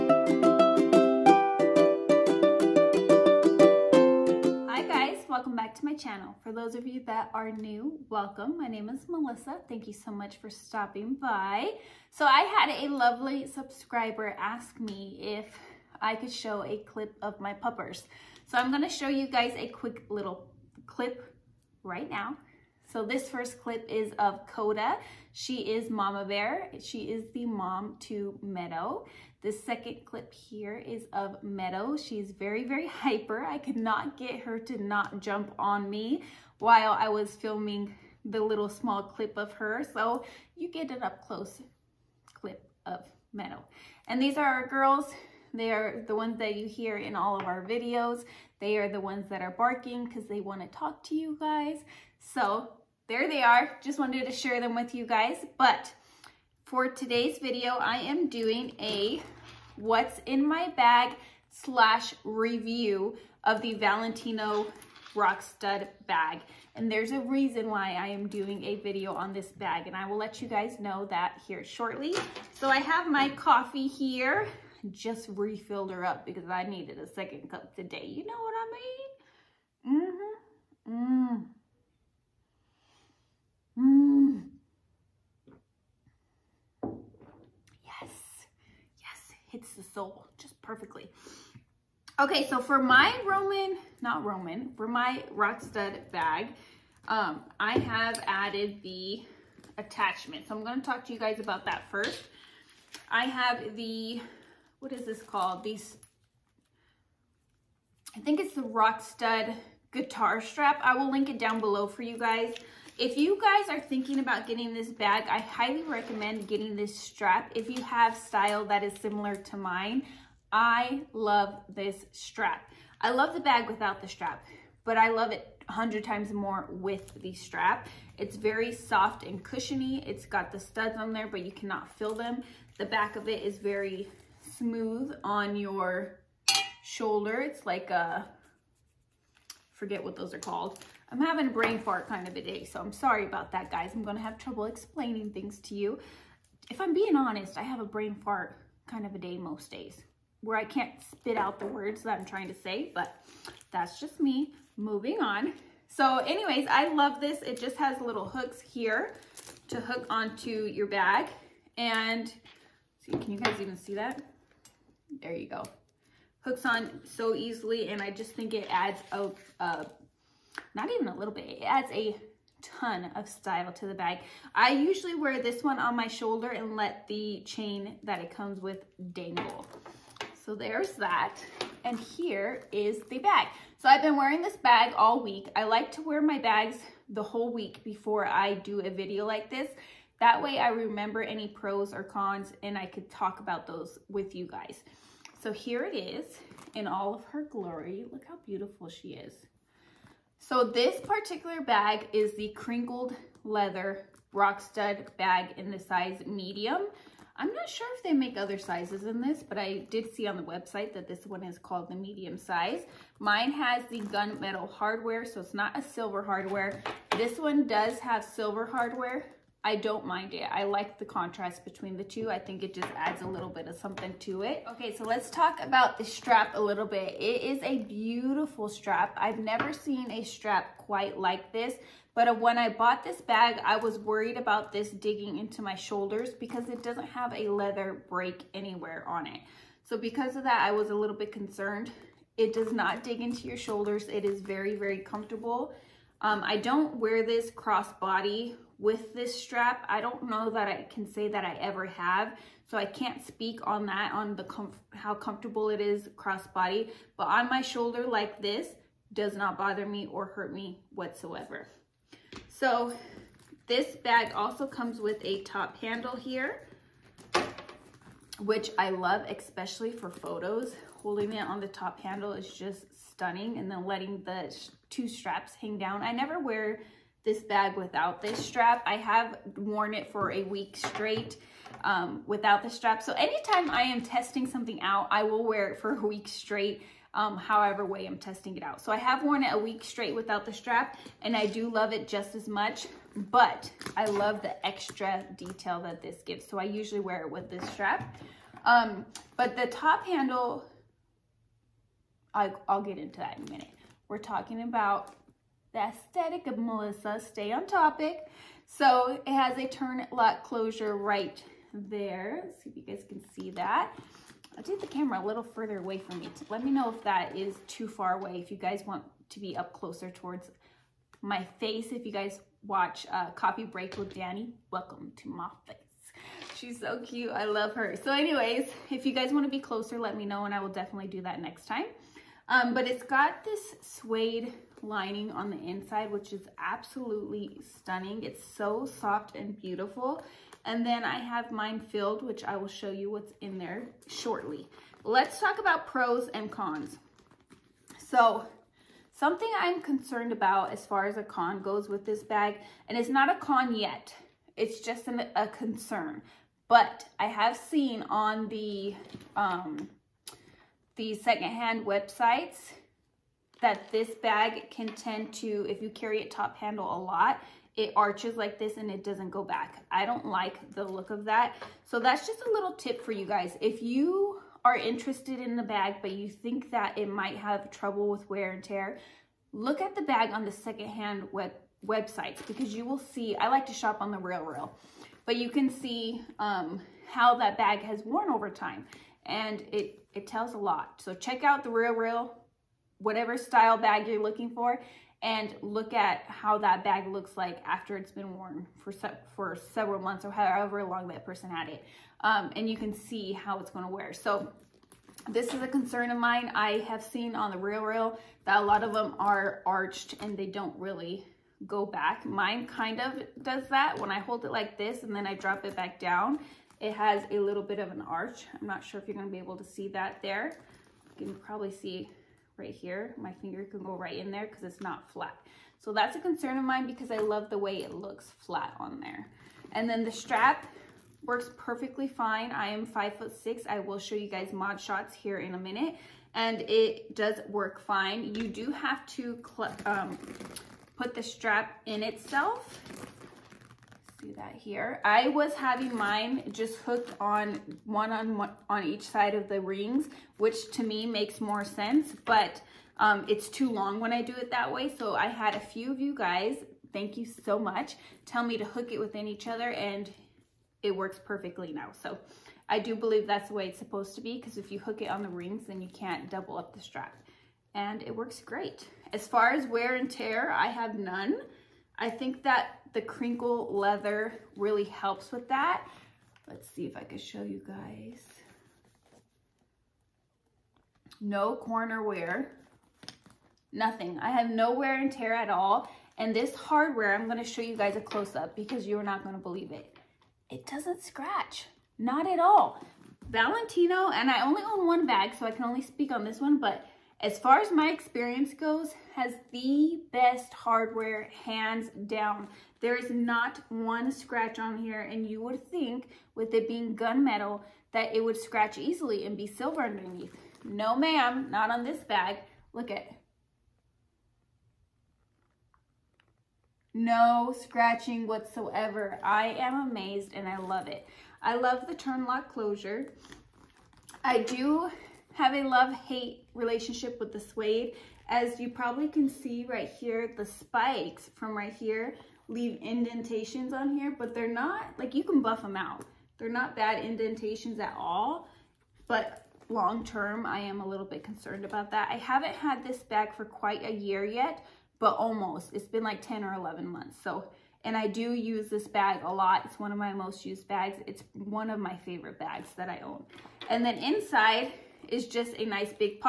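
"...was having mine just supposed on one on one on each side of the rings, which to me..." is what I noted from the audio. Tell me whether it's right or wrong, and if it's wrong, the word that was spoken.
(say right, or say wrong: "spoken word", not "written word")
wrong: "hooked", not "supposed".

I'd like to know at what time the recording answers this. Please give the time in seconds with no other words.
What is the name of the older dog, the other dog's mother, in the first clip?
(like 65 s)
24 s.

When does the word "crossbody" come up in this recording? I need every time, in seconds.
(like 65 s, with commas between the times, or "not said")
247 s, 256 s.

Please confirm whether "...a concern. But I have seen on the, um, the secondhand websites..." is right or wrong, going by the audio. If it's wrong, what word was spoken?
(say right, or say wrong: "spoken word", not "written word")
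right.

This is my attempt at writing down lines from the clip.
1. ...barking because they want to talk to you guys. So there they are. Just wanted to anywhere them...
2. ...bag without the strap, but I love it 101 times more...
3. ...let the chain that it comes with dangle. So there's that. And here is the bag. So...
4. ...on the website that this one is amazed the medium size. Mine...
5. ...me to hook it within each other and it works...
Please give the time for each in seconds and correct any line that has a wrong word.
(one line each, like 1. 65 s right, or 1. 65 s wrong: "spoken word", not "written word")
1. 49 s wrong: "share", not "anywhere"
2. 123 s wrong: "100", not "101"
3. 176 s right
4. 210 s wrong: "called", not "amazed"
5. 458 s right.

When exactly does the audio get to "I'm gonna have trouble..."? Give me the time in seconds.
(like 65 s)
143 s.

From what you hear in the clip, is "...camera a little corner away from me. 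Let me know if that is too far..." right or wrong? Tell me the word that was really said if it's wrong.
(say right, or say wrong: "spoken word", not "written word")
wrong: "further", not "corner".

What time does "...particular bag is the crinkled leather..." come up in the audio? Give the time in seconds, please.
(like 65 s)
201 s.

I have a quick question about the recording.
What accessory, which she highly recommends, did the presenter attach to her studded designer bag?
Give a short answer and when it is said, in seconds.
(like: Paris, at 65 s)
Rockstud guitar strap, at 108 s.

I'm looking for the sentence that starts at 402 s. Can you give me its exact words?
Um, and you can see how it's gonna wear.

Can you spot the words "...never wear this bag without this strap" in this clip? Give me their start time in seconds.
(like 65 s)
276 s.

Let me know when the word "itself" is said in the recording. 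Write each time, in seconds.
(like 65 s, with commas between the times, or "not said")
442 s.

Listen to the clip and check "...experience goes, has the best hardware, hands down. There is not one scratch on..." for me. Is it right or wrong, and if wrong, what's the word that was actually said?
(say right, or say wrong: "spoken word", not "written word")
right.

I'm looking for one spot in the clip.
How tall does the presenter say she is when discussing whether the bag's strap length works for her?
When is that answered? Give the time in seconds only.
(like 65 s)
432 s.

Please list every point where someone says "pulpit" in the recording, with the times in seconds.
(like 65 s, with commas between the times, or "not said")
not said.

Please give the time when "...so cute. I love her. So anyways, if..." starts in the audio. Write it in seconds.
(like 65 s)
326 s.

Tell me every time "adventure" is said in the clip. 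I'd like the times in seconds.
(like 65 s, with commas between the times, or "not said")
not said.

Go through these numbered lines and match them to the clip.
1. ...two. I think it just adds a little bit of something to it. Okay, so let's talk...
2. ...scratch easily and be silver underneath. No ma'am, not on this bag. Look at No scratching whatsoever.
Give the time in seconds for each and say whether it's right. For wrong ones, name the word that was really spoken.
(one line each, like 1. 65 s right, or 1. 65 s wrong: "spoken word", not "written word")
1. 222 s right
2. 508 s right.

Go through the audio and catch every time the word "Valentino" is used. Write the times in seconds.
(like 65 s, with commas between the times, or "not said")
63 s, 493 s.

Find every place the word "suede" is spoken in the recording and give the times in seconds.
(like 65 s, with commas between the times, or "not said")
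333 s, 527 s.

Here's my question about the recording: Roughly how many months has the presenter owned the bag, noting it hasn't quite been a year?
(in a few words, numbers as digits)
10 or 11 months.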